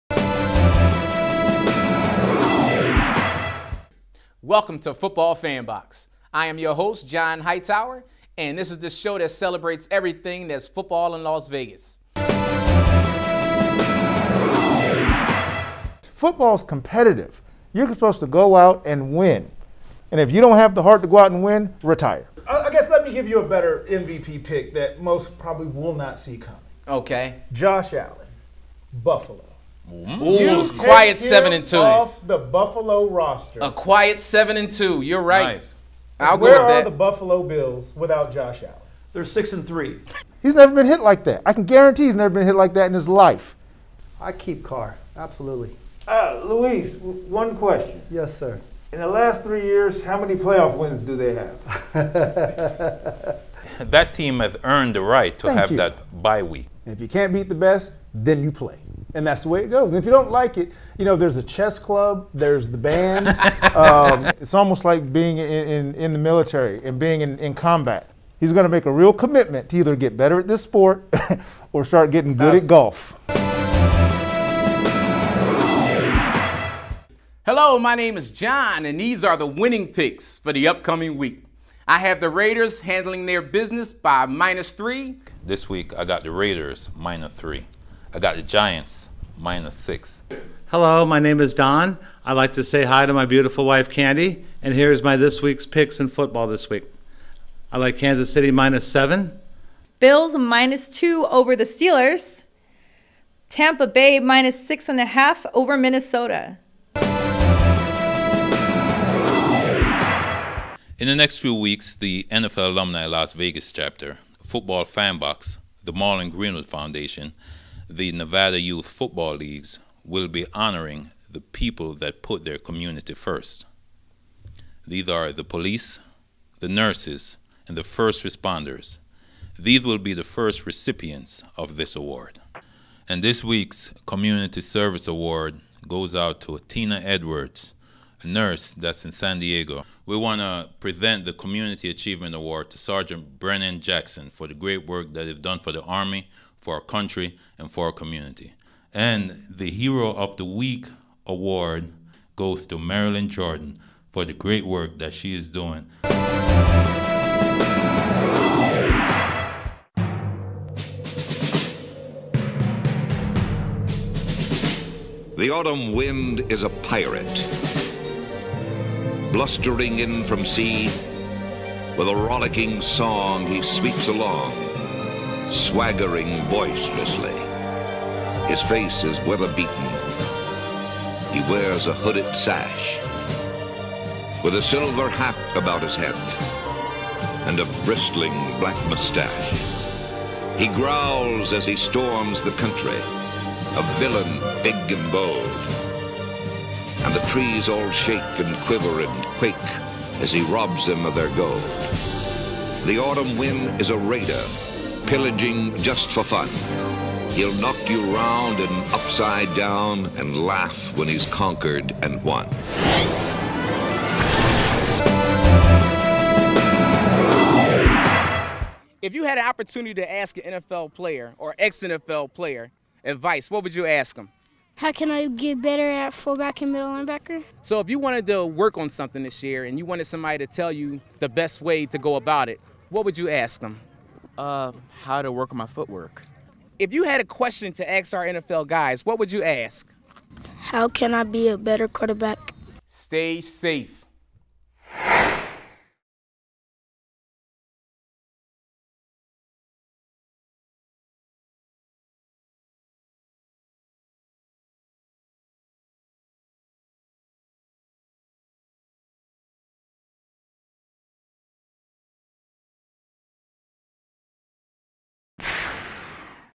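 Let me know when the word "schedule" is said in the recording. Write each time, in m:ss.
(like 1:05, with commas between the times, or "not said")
not said.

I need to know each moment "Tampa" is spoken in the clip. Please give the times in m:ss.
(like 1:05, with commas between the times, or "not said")
1:43.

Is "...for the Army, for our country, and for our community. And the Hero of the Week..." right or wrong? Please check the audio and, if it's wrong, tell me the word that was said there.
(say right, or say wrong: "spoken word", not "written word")
right.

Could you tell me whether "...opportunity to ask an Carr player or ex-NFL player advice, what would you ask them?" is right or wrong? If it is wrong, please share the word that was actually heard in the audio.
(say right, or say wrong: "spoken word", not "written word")
wrong: "NFL", not "Carr".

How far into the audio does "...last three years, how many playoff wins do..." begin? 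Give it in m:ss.
0:49.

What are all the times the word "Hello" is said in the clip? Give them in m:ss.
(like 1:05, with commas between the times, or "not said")
1:17, 1:30.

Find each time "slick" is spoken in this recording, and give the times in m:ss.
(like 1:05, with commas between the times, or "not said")
not said.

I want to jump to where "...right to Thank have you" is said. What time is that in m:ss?
0:55.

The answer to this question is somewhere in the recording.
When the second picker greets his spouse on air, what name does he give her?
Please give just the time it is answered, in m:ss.
1:33.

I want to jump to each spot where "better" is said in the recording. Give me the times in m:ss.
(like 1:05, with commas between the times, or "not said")
0:23, 1:10, 3:45, 4:01.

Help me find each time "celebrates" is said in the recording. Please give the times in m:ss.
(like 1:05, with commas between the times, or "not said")
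0:09.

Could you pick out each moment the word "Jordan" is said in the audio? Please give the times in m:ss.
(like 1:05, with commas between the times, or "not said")
2:33.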